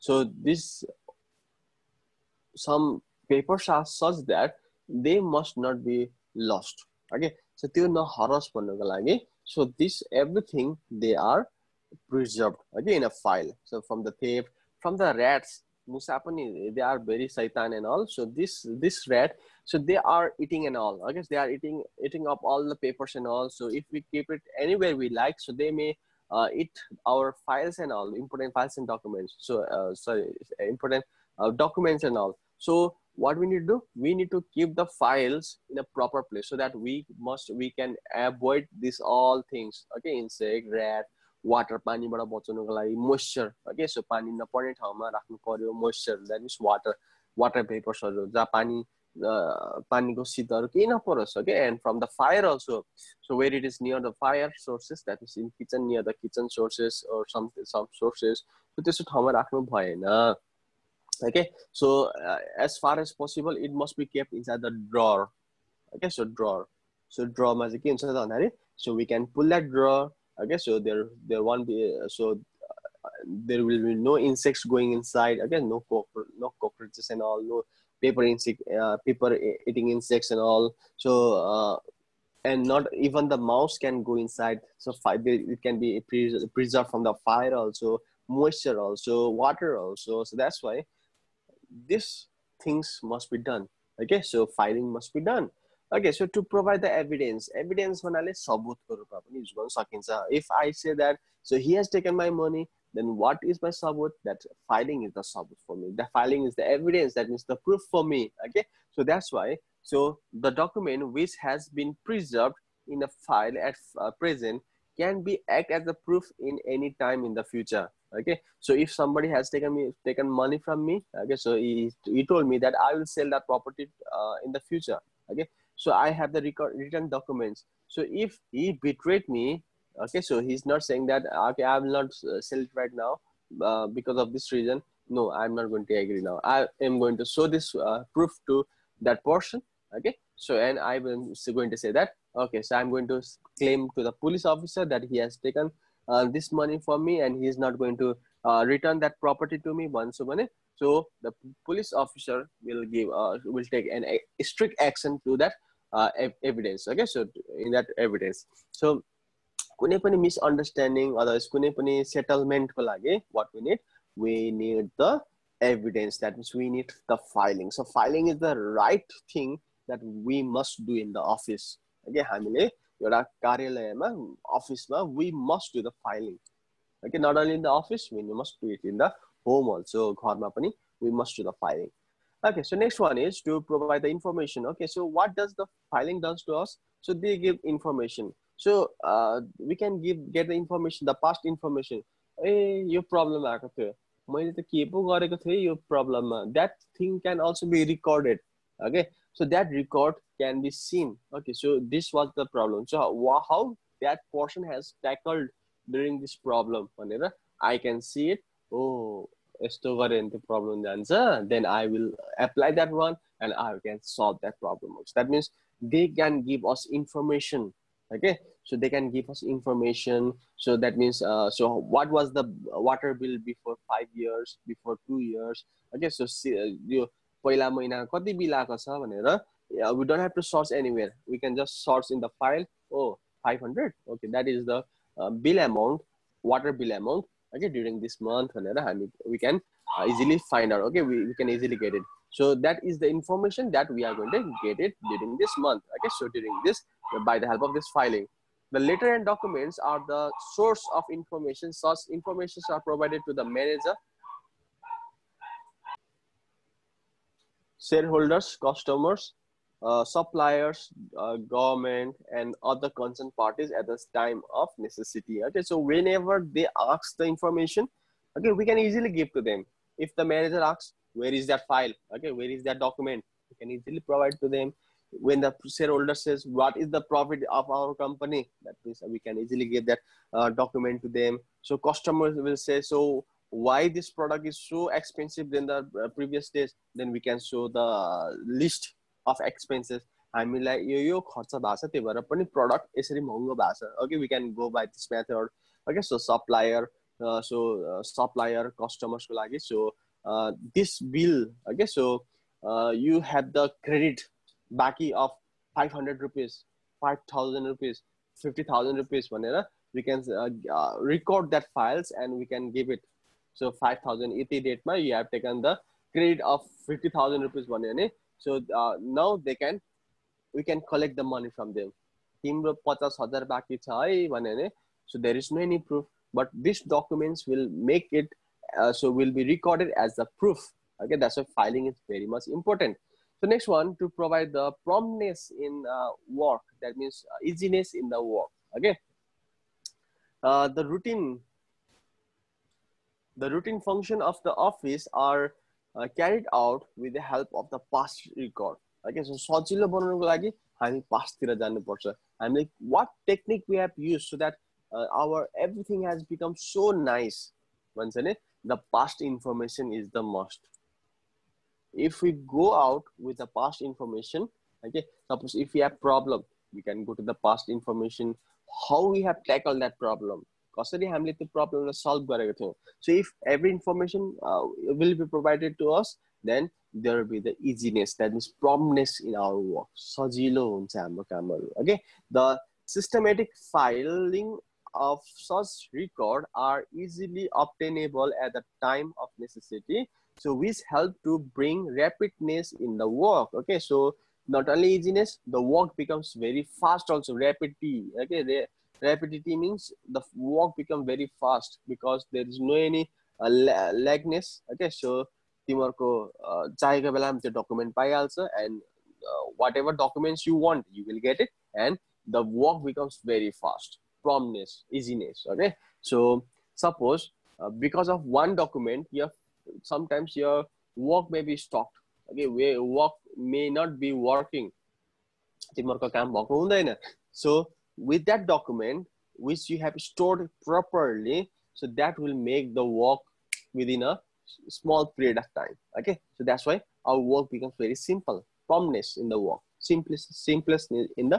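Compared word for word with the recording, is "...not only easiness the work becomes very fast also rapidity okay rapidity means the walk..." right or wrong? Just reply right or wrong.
right.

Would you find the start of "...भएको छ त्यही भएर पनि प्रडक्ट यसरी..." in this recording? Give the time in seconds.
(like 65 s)
291 s.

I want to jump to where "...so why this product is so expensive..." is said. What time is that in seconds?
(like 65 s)
282 s.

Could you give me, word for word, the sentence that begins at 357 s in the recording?
Once in it, the past information is the most.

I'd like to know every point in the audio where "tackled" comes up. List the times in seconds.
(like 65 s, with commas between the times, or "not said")
205 s, 369 s.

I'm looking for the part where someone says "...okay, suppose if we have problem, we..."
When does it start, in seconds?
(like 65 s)
364 s.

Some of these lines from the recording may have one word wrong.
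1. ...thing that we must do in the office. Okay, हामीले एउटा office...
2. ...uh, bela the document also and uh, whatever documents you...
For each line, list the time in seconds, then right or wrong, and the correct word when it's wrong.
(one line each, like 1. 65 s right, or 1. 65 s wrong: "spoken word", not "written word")
1. 169 s right
2. 407 s right.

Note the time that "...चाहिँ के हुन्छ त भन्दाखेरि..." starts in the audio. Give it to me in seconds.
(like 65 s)
67 s.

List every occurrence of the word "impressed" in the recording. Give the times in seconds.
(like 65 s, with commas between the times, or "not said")
not said.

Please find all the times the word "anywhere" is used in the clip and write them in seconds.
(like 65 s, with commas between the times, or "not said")
24 s, 230 s.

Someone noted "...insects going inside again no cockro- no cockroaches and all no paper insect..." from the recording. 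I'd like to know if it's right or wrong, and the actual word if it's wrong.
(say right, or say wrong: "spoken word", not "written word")
right.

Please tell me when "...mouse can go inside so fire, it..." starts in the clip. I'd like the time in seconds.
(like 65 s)
83 s.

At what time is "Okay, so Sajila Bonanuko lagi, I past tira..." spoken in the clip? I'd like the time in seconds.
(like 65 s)
349 s.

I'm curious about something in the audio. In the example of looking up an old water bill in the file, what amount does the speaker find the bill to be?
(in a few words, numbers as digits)
500.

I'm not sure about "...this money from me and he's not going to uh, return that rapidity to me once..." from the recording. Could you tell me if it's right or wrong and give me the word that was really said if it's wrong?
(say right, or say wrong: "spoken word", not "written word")
wrong: "property", not "rapidity".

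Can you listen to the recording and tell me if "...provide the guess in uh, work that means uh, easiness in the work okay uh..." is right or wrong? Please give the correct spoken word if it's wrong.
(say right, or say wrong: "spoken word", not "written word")
wrong: "promptness", not "guess".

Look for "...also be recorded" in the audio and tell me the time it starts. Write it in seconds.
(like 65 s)
197 s.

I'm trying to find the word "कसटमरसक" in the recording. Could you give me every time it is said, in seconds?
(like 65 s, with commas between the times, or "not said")
298 s.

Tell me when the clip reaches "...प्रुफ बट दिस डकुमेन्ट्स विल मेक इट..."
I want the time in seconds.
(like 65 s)
325 s.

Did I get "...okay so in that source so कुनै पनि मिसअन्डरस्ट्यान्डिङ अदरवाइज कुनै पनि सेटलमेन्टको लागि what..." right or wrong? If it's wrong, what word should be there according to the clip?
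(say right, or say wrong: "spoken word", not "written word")
wrong: "evidence", not "source".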